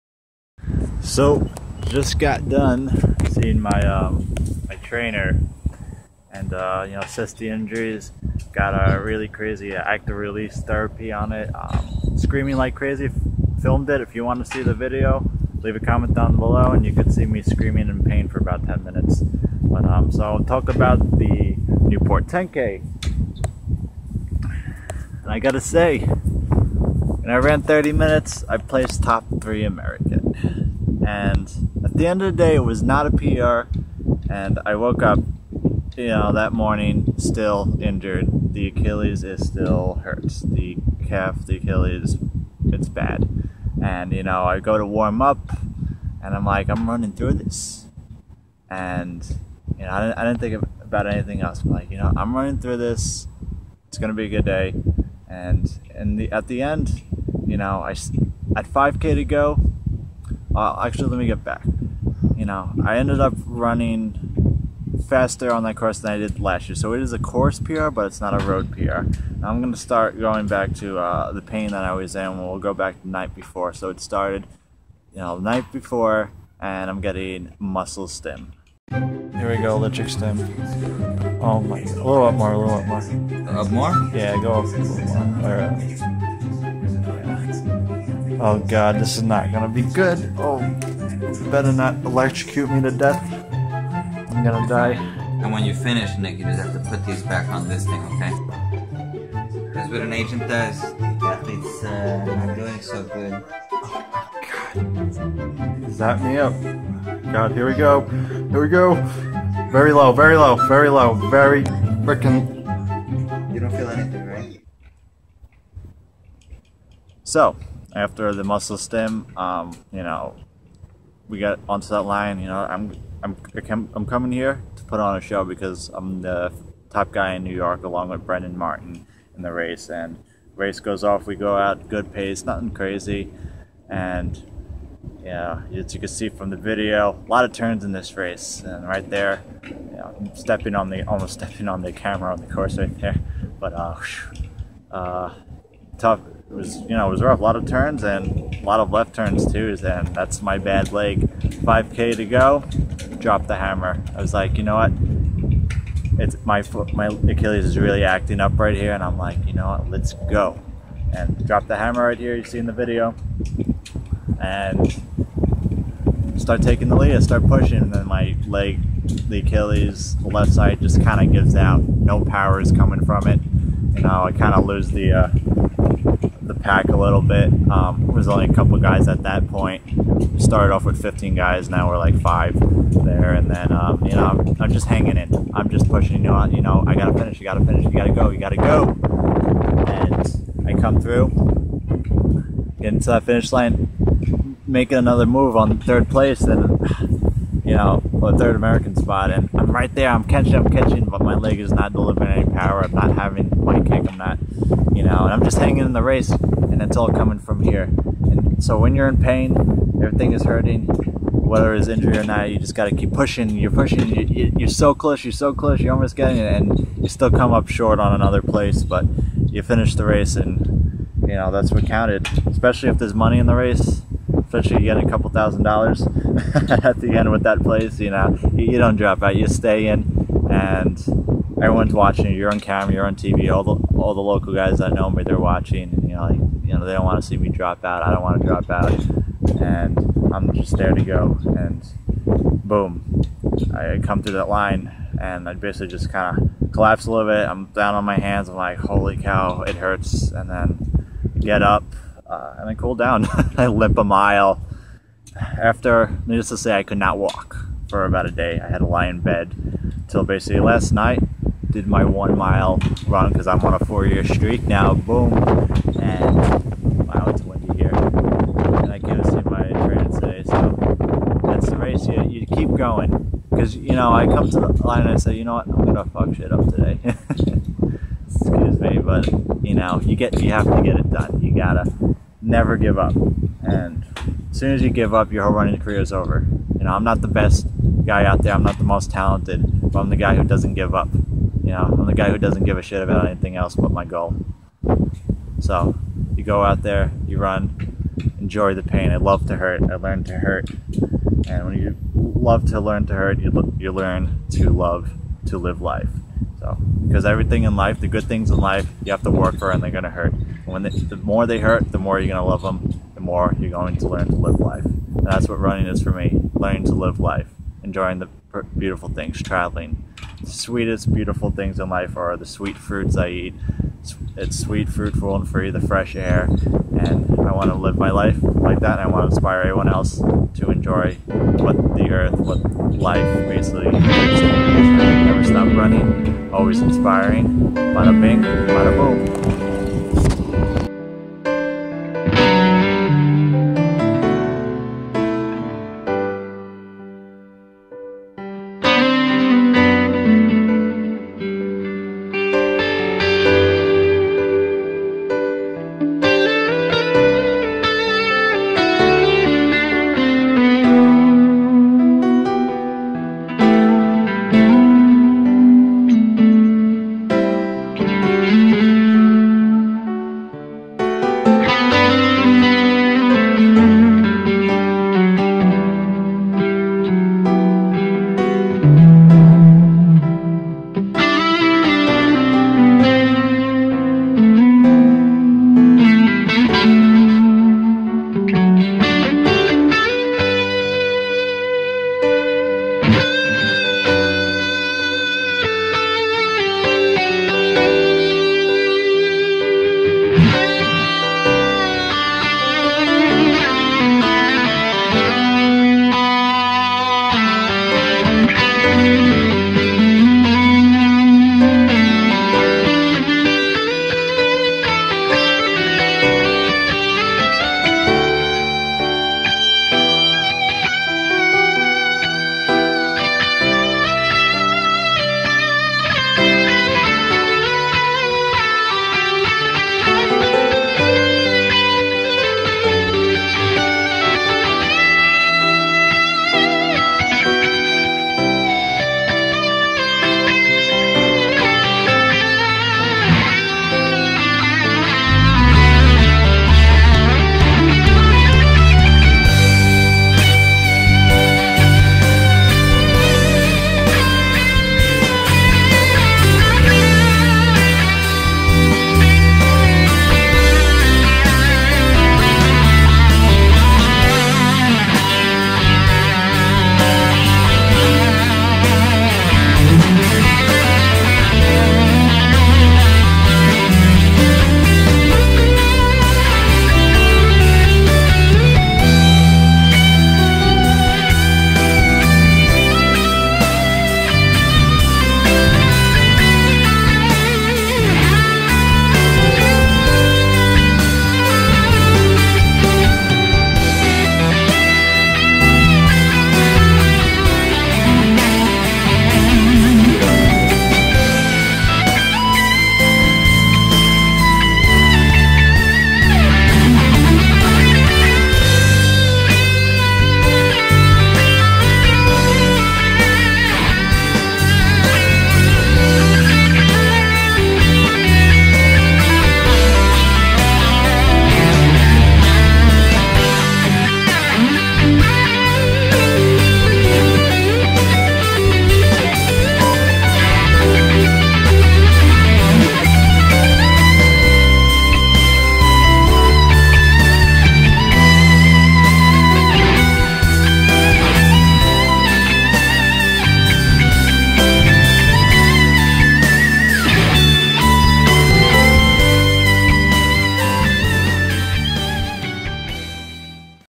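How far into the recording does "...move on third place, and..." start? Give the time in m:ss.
3:15.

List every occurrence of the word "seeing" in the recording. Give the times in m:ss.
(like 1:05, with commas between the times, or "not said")
0:03.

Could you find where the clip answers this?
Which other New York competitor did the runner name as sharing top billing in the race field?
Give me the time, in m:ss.
2:08.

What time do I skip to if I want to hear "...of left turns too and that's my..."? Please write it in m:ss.
2:28.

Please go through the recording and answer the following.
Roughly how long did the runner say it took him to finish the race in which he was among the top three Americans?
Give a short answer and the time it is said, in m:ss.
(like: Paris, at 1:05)
30 minutes, at 0:27.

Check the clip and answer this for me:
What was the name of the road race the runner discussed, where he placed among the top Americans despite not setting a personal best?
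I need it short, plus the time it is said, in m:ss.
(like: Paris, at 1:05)
Newport 10K, at 0:21.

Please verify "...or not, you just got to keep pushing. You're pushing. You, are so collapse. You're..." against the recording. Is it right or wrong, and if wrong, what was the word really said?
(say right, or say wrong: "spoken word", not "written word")
wrong: "close", not "collapse".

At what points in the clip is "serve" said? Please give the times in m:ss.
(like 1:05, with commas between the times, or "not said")
not said.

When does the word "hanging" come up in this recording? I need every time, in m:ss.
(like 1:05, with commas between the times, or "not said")
3:04, 3:25.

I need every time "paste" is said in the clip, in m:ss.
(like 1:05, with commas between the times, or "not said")
not said.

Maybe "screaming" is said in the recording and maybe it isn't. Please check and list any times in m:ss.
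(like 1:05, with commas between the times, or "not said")
0:12, 0:17.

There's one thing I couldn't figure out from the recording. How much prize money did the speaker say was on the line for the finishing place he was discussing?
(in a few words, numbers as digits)
a couple thousand dollars.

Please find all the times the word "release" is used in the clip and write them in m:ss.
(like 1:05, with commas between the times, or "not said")
0:10.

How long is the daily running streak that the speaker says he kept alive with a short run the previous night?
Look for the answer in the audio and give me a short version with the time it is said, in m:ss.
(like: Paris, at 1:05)
4 years, at 4:23.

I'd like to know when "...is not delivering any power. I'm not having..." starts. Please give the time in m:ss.
3:21.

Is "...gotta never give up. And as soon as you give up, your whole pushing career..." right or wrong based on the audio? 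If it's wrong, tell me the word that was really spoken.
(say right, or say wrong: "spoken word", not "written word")
wrong: "running", not "pushing".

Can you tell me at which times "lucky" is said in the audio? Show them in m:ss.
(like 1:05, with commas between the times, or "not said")
not said.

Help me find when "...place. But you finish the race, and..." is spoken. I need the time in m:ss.
3:38.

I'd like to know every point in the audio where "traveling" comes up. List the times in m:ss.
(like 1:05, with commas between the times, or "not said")
5:19.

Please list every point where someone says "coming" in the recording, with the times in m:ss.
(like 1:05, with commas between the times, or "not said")
2:04, 2:52, 3:27.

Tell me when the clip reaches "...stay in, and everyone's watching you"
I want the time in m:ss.
3:49.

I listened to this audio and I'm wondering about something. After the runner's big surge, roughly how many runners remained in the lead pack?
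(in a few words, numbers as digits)
5.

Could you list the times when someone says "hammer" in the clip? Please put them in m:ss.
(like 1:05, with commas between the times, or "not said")
2:33, 2:41.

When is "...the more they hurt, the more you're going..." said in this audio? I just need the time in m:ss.
5:10.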